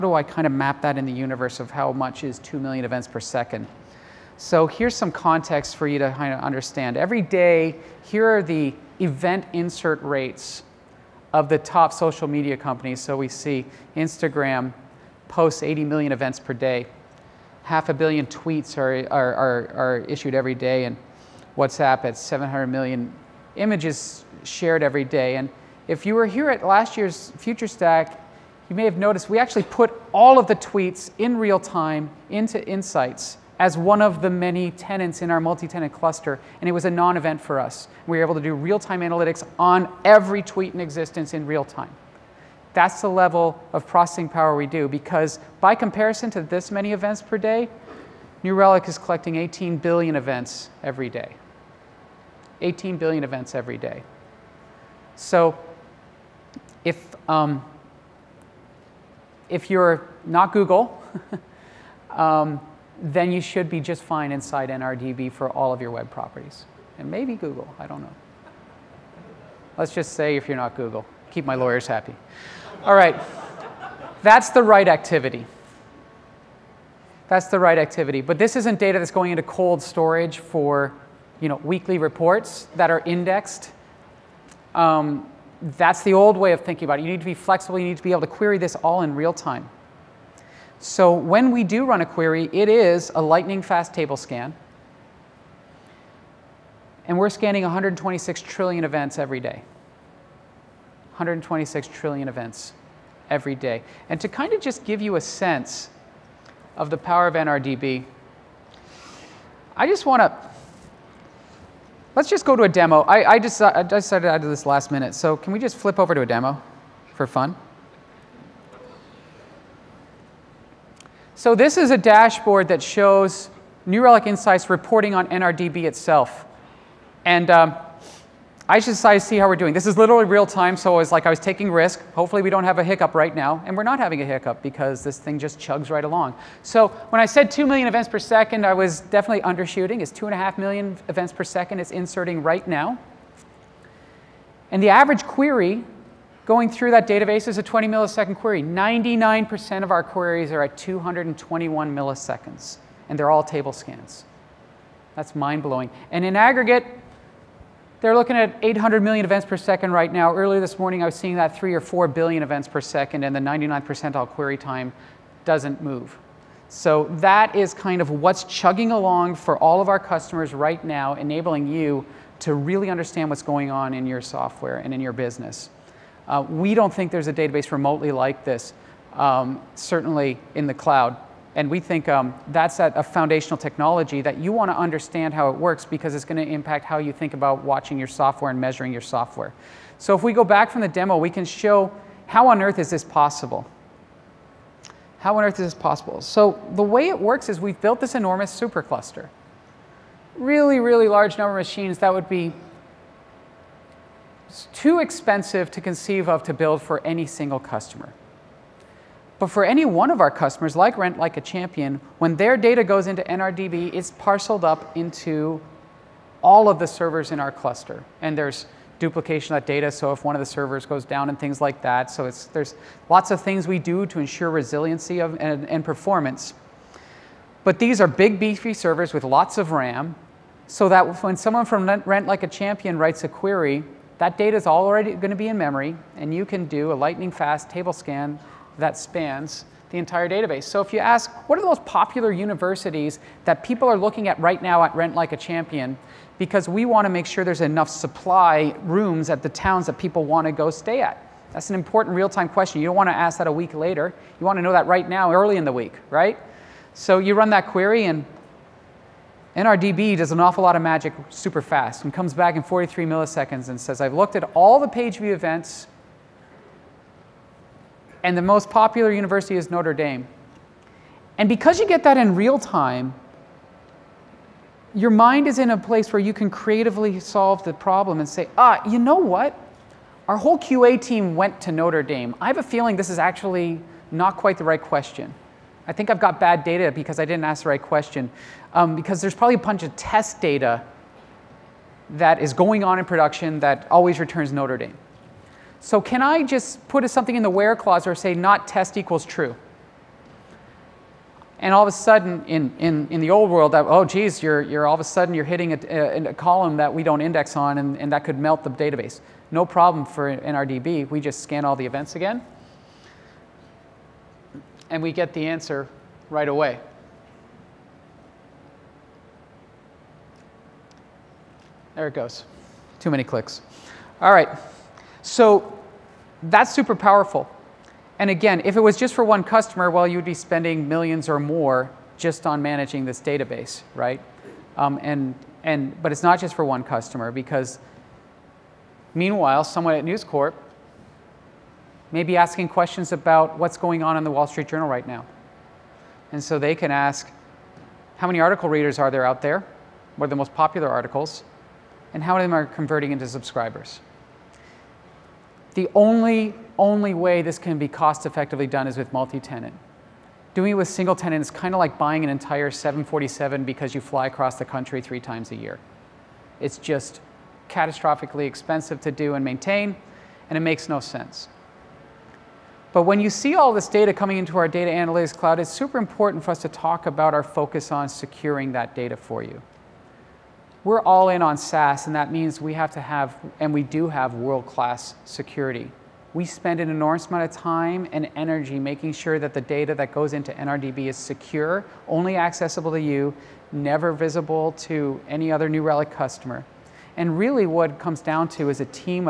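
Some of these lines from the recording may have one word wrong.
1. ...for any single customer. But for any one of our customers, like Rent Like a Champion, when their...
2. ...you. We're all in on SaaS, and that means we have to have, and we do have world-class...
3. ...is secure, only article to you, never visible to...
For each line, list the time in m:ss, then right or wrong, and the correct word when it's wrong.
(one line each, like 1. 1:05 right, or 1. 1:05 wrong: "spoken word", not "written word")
1. 3:26 right
2. 6:19 right
3. 6:31 wrong: "accessible", not "article".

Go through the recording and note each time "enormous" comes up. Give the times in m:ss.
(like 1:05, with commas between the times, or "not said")
3:18, 6:26.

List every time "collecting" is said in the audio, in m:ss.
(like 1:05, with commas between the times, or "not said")
0:48.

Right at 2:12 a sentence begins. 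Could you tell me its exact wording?
Hopefully we don't have a hiccup right now, and we're not having a hiccup because this thing just chugs right along.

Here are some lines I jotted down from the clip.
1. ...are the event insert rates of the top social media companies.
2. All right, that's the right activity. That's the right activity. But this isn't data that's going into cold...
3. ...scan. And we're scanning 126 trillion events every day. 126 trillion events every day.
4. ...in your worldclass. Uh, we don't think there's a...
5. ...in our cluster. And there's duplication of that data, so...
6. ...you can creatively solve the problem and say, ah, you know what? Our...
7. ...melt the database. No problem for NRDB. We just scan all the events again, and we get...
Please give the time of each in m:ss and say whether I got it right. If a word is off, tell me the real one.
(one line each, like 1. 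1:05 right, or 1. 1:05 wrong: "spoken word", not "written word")
1. 0:08 right
2. 1:12 right
3. 1:34 right
4. 2:54 wrong: "business", not "worldclass"
5. 3:37 right
6. 4:36 right
7. 5:08 right.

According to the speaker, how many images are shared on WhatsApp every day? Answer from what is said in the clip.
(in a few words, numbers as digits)
700 million.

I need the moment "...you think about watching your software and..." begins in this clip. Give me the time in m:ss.
3:06.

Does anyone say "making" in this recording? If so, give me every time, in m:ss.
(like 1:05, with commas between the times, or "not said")
6:28.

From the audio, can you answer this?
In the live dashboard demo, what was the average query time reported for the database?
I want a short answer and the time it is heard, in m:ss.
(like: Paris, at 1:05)
20 milliseconds, at 2:27.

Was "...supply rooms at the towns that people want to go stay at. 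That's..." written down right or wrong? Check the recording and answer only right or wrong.
right.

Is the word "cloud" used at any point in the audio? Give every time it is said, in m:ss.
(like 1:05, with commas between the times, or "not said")
3:00, 6:15.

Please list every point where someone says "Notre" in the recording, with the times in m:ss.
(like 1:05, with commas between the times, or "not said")
4:29, 4:41, 4:54.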